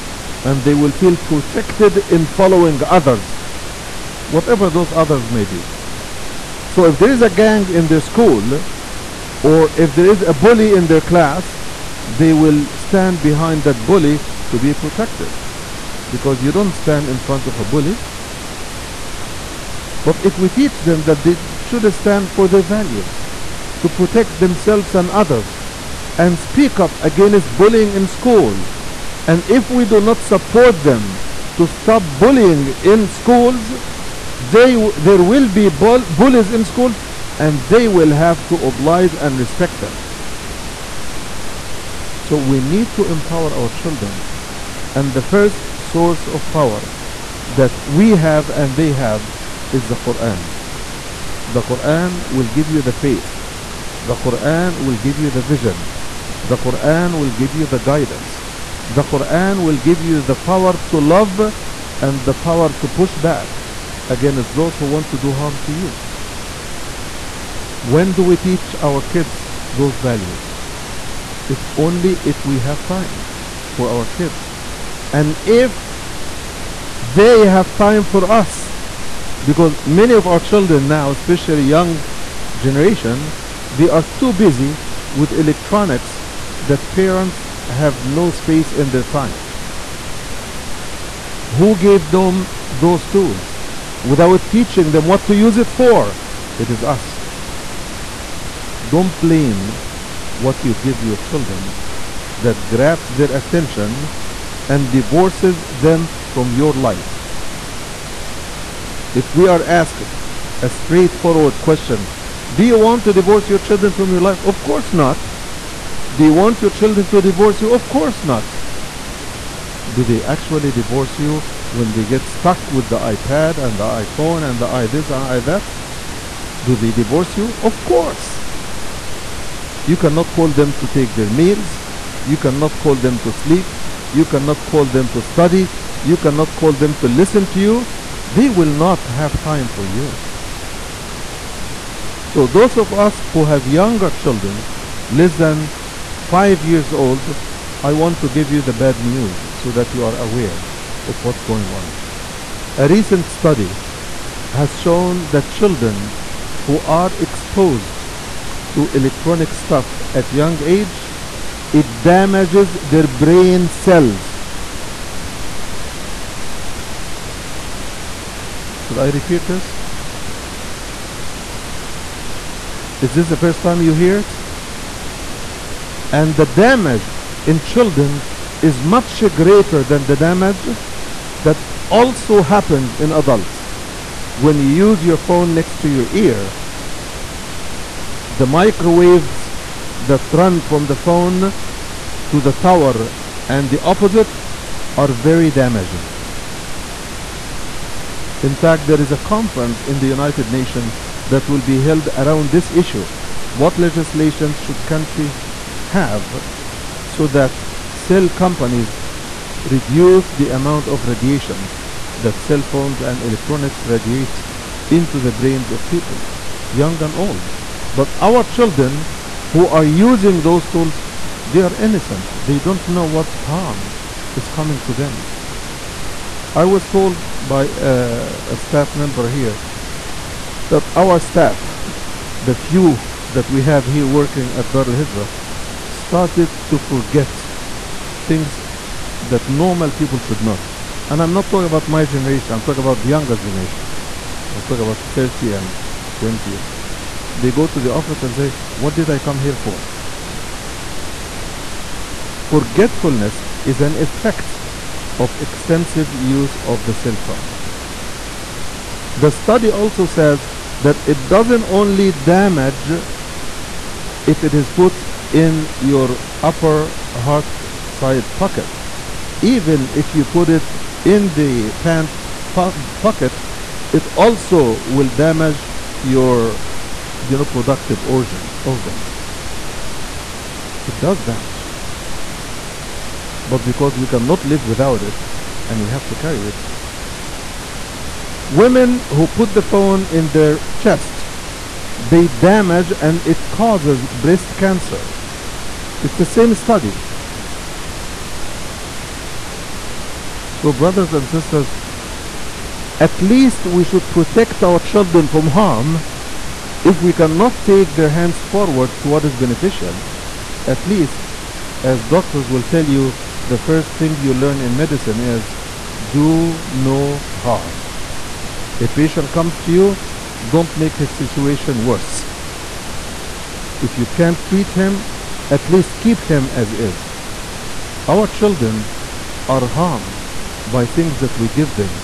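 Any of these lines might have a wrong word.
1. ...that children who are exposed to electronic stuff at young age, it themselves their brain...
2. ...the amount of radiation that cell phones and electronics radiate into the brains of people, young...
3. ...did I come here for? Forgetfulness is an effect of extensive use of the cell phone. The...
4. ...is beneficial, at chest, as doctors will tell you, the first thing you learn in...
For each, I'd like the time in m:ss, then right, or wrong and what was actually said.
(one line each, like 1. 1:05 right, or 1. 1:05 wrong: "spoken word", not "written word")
1. 2:35 wrong: "damages", not "themselves"
2. 3:30 right
3. 4:08 right
4. 5:09 wrong: "least", not "chest".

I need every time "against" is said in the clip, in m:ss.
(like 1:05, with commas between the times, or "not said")
0:27, 1:04.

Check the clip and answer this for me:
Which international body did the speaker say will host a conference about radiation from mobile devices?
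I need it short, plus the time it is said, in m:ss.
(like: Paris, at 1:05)
United Nations, at 3:20.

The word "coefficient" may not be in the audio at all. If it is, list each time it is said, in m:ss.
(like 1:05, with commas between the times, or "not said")
not said.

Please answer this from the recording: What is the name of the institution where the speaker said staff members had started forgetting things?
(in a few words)
Dar al Hijra.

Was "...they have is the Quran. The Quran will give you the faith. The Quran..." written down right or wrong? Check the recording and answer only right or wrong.
right.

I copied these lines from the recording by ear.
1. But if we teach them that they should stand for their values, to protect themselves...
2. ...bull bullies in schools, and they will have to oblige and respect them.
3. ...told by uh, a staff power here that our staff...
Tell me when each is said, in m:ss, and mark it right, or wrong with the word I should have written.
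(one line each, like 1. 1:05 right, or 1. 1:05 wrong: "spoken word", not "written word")
1. 0:20 right
2. 0:35 right
3. 3:46 wrong: "member", not "power".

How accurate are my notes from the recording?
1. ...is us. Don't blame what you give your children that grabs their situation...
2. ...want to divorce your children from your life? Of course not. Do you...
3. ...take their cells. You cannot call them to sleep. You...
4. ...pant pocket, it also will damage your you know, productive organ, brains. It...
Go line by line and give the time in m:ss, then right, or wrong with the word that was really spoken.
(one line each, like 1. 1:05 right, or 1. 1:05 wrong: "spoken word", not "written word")
1. 1:36 wrong: "attention", not "situation"
2. 1:52 right
3. 2:10 wrong: "meals", not "cells"
4. 4:31 wrong: "organs", not "brains".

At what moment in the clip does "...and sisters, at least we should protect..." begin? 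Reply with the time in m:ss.
5:01.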